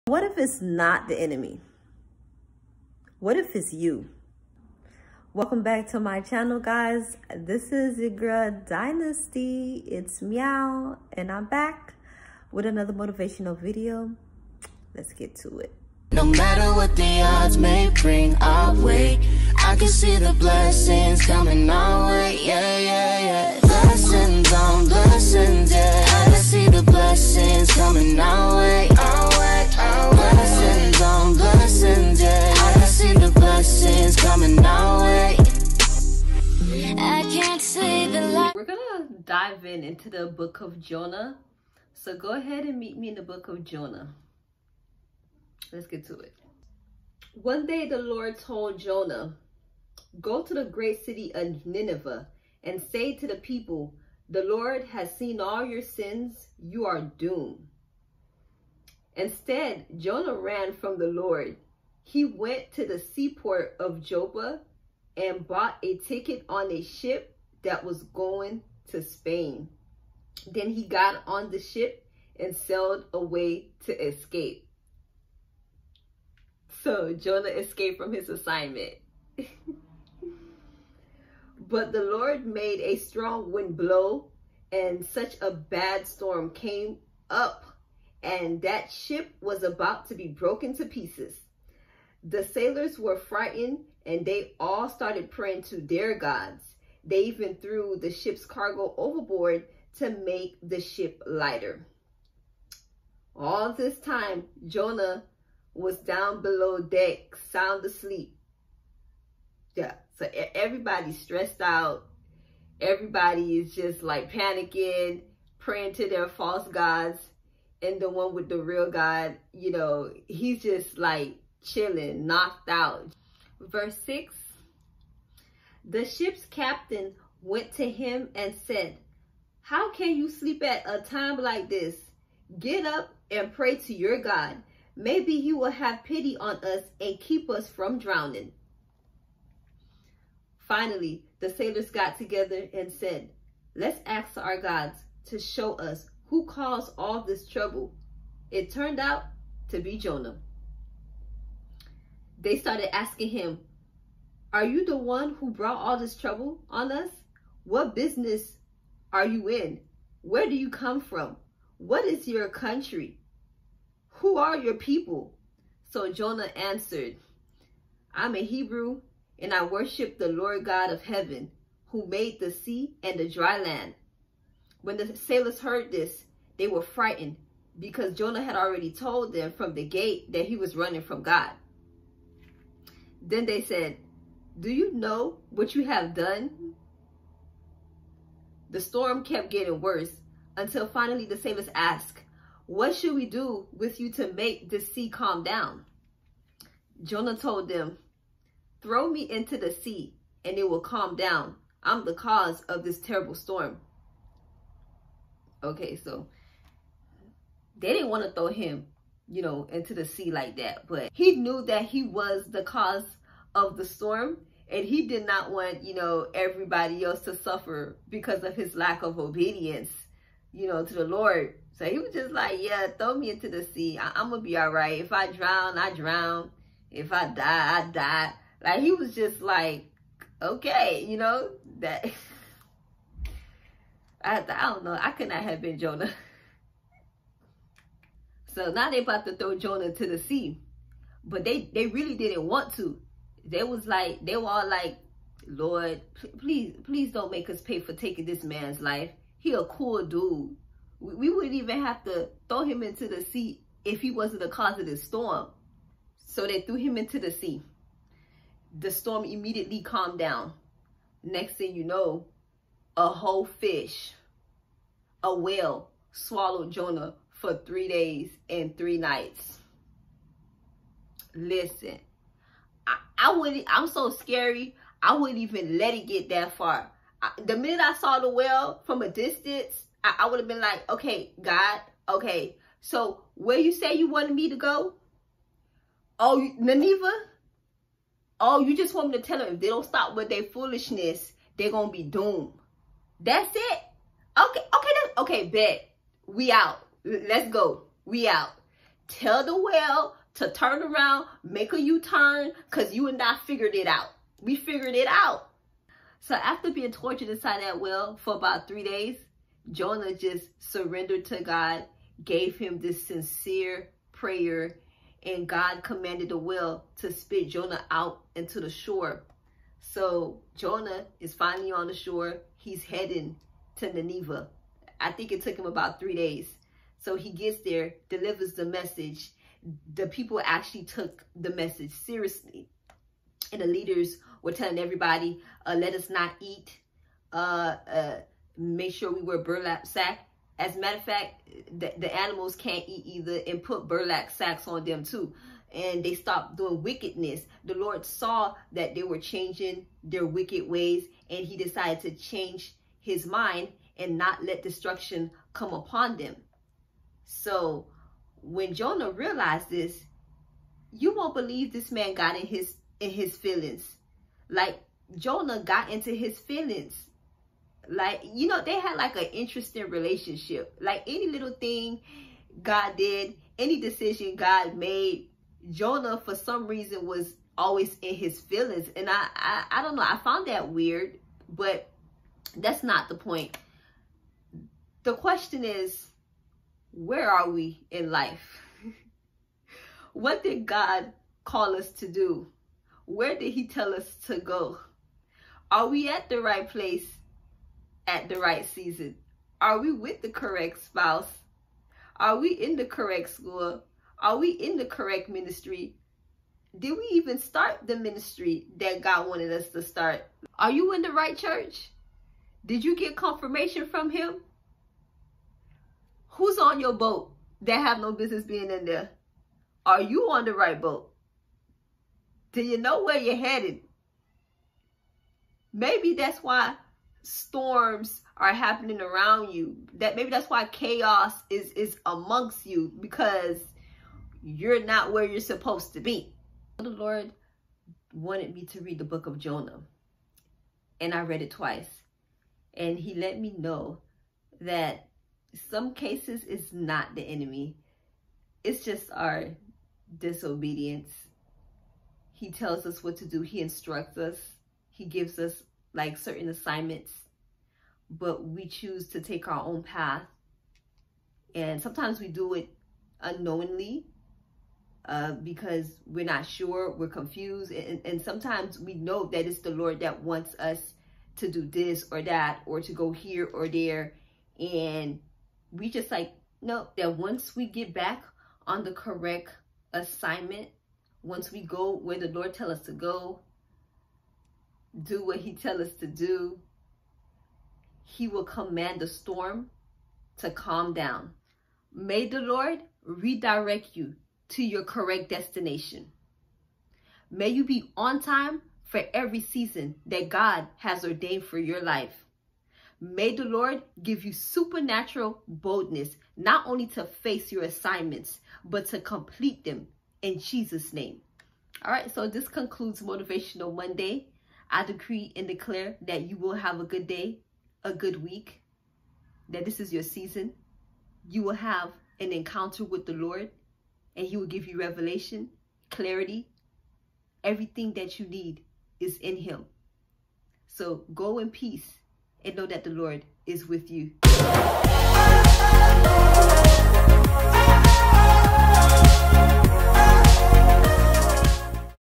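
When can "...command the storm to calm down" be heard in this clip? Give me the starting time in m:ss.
8:08.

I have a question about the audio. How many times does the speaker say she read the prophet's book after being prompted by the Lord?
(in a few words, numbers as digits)
Twice.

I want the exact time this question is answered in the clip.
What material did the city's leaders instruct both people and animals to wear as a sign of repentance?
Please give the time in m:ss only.
5:39.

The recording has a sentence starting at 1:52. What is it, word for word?
Everybody is just like panicking, praying to their false gods.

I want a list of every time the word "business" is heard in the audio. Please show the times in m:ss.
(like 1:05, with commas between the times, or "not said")
2:37, 6:58.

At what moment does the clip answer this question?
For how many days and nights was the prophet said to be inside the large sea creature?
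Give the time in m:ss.
4:27.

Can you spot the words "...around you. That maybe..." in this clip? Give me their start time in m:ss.
7:09.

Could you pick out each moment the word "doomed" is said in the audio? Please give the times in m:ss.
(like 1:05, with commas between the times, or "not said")
0:57, 4:52.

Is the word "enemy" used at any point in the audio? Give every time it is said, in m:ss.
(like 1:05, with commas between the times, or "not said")
0:01, 7:27.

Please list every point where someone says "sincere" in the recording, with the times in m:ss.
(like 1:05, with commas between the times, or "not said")
5:13.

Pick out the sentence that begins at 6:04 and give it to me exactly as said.
Like Jonah got into his feelings.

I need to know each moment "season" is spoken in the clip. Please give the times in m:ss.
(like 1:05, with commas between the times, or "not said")
6:38, 8:19, 8:40.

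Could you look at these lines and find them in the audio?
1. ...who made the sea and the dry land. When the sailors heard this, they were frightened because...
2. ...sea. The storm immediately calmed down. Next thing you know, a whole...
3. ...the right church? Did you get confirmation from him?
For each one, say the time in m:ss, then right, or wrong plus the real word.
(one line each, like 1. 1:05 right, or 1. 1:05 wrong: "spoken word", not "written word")
1. 2:51 right
2. 4:17 right
3. 6:51 right.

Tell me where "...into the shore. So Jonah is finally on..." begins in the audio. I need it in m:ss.
5:18.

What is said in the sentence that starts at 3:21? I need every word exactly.
I'm the cause of this terrible storm.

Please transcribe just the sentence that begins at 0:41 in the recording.
So go ahead and meet me in the book of Jonah.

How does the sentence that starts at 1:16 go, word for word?
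So Jonah escaped from his assignment.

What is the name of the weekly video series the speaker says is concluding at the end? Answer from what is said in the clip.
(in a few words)
Motivational Monday.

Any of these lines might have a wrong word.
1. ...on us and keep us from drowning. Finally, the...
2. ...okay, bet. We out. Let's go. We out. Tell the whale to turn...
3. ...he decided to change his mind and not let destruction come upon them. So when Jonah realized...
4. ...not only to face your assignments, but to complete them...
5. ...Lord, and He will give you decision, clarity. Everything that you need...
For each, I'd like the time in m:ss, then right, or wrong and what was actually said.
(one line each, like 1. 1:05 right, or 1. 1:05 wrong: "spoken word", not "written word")
1. 2:16 right
2. 4:55 right
3. 5:51 right
4. 8:26 right
5. 8:43 wrong: "revelation", not "decision".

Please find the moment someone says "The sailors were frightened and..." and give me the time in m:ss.
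1:32.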